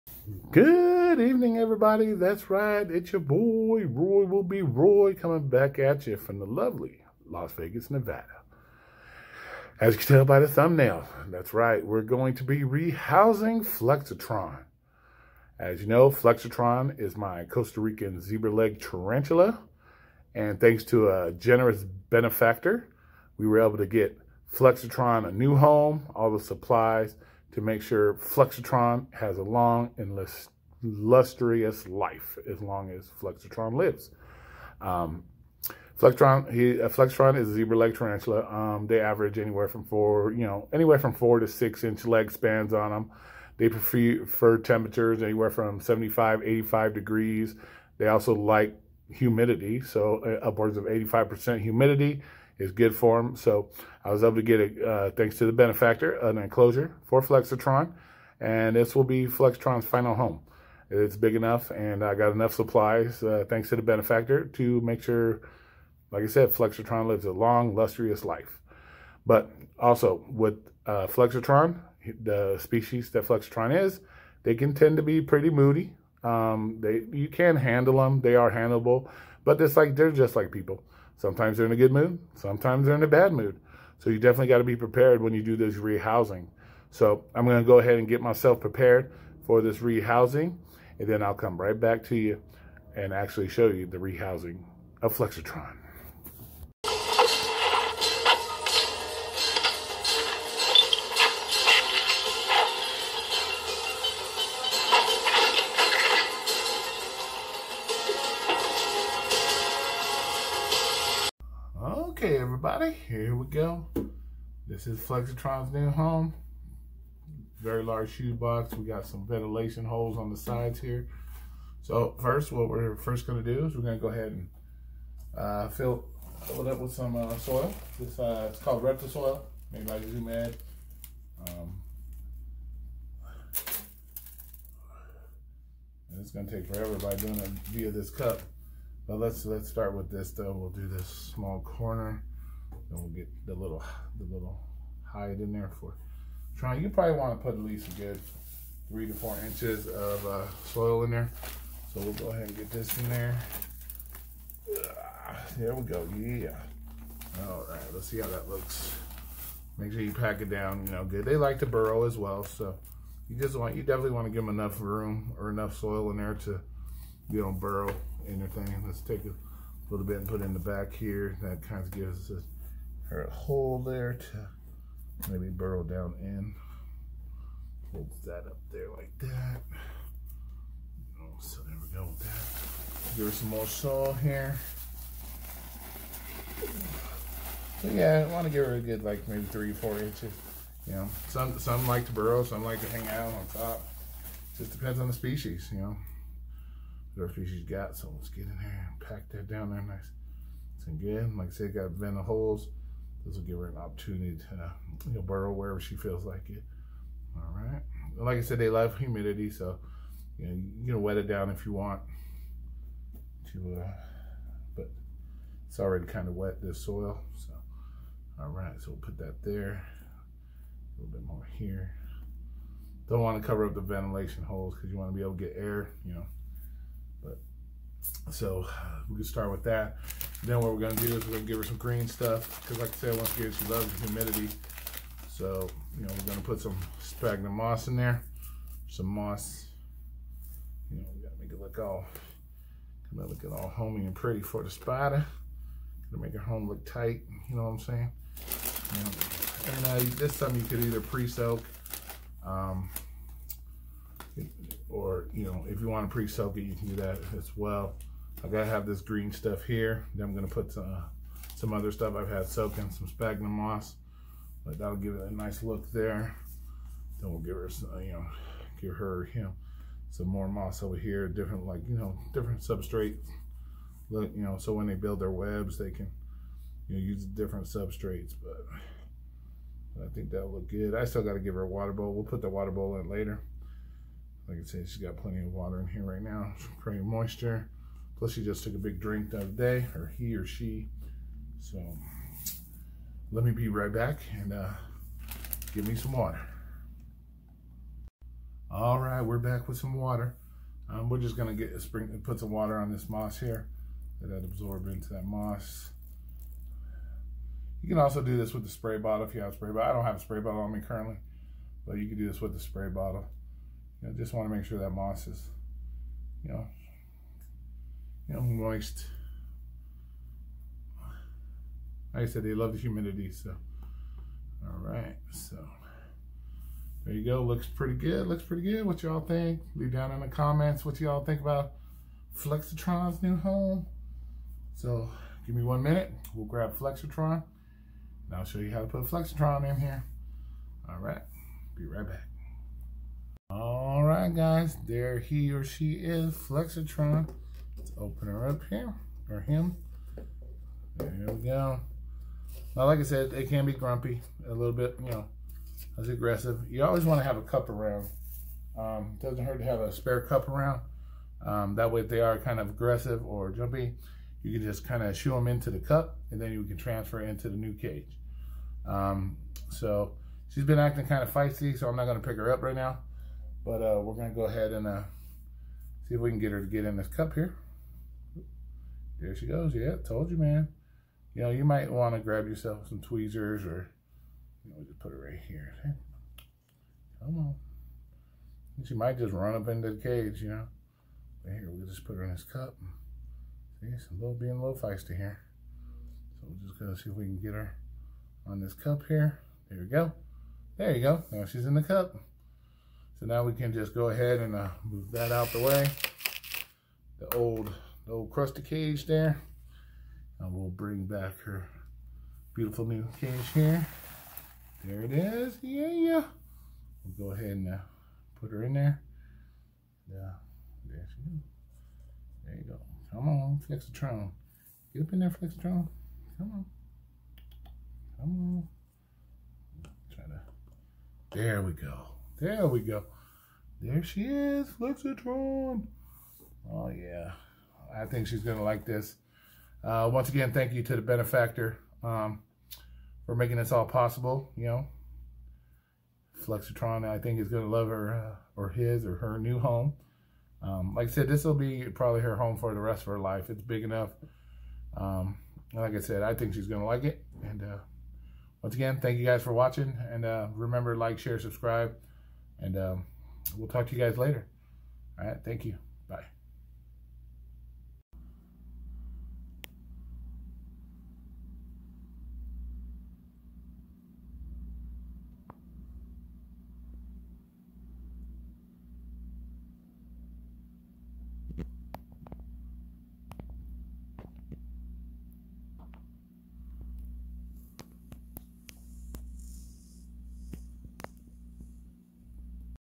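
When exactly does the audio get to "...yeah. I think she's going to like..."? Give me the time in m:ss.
7:16.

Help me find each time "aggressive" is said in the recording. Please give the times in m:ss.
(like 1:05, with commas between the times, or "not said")
5:56, 6:02.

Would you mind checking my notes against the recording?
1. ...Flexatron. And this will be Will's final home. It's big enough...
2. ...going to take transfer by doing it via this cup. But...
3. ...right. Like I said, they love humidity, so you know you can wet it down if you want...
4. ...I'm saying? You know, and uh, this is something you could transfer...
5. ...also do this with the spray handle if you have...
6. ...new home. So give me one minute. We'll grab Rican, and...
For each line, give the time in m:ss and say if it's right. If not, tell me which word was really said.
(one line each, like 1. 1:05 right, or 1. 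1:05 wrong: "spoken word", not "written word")
1. 0:57 wrong: "Flexatron", not "Will"
2. 2:16 wrong: "forever", not "transfer"
3. 3:27 right
4. 4:07 wrong: "either", not "transfer"
5. 5:07 wrong: "bottle", not "handle"
6. 5:33 wrong: "Flexatron", not "Rican".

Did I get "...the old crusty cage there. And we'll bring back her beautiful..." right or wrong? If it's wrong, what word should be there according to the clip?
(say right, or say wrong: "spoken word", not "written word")
right.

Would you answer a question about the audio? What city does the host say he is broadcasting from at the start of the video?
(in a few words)
Las Vegas.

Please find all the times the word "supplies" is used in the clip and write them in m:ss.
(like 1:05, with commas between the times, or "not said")
0:26, 1:02.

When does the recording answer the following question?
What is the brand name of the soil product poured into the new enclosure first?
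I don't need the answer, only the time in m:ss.
2:08.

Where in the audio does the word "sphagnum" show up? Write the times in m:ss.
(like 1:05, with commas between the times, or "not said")
3:56, 4:23.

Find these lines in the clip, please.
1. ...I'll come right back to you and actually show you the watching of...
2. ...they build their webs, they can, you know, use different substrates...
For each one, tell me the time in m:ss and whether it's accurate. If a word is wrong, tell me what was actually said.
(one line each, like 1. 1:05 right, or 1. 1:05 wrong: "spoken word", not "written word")
1. 1:31 wrong: "rehousing", not "watching"
2. 4:34 right.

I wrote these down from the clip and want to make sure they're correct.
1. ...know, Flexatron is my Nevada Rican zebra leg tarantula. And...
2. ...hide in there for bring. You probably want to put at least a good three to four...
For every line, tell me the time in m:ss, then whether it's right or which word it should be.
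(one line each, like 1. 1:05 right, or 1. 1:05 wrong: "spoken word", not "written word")
1. 0:15 wrong: "Costa", not "Nevada"
2. 2:25 wrong: "trying", not "bring".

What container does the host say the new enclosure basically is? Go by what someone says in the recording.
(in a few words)
shoebox.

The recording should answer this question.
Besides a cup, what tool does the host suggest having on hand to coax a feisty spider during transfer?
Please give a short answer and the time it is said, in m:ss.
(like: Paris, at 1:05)
tweezers, at 6:23.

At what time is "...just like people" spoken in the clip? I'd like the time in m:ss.
1:20.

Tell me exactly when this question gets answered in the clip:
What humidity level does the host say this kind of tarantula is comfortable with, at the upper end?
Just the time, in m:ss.
0:50.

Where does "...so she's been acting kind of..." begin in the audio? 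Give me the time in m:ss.
6:09.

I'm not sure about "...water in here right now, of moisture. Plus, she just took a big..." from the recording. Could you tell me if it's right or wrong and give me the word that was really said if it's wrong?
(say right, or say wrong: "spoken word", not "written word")
right.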